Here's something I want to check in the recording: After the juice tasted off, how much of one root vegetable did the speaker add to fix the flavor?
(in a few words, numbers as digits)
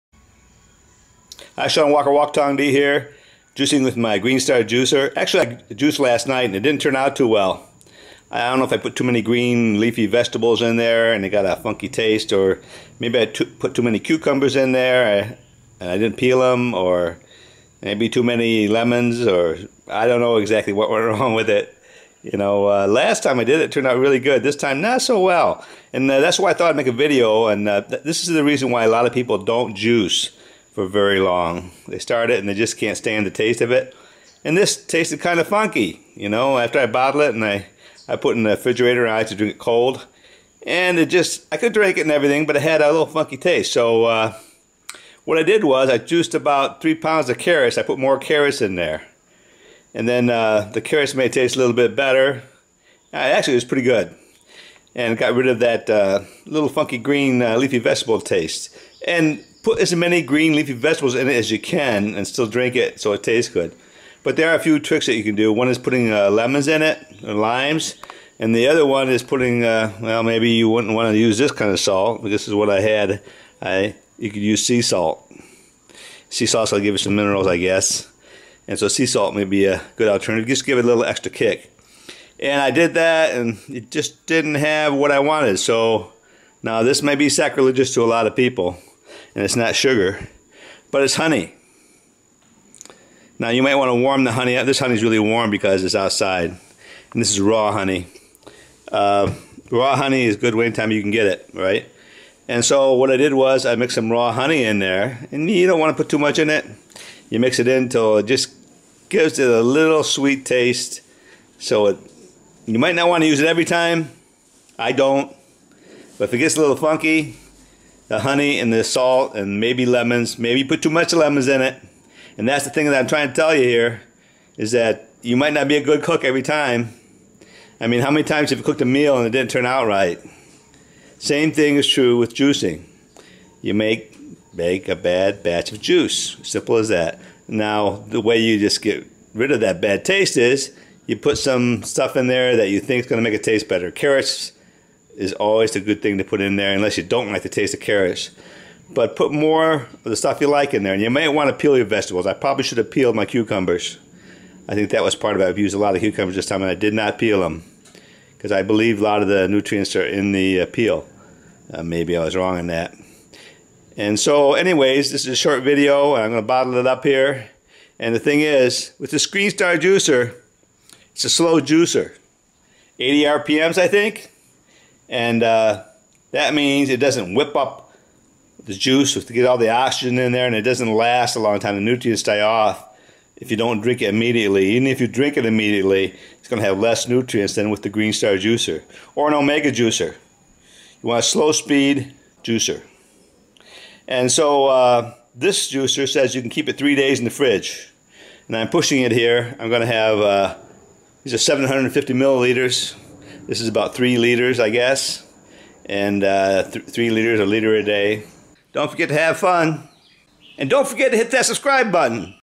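3 pounds.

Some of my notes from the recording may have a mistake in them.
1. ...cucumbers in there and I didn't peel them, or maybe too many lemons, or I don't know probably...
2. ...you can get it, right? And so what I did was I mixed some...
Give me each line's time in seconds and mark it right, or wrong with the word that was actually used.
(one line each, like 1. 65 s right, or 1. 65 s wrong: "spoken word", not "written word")
1. 13 s wrong: "exactly", not "probably"
2. 100 s right.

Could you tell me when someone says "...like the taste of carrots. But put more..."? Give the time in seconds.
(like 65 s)
147 s.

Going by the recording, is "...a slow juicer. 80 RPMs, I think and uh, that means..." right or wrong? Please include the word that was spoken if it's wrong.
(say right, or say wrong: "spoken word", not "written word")
right.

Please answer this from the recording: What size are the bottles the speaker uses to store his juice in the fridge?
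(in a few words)
750 milliliters.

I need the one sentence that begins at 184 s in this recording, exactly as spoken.
Even if you drink it immediately, it's going to have less nutrients than with the Green Star juicer or an Omega juicer.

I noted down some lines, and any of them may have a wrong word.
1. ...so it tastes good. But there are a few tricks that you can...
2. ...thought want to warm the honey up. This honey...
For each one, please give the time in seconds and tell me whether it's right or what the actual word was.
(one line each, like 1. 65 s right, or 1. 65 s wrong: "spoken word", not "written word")
1. 62 s right
2. 93 s wrong: "might", not "thought".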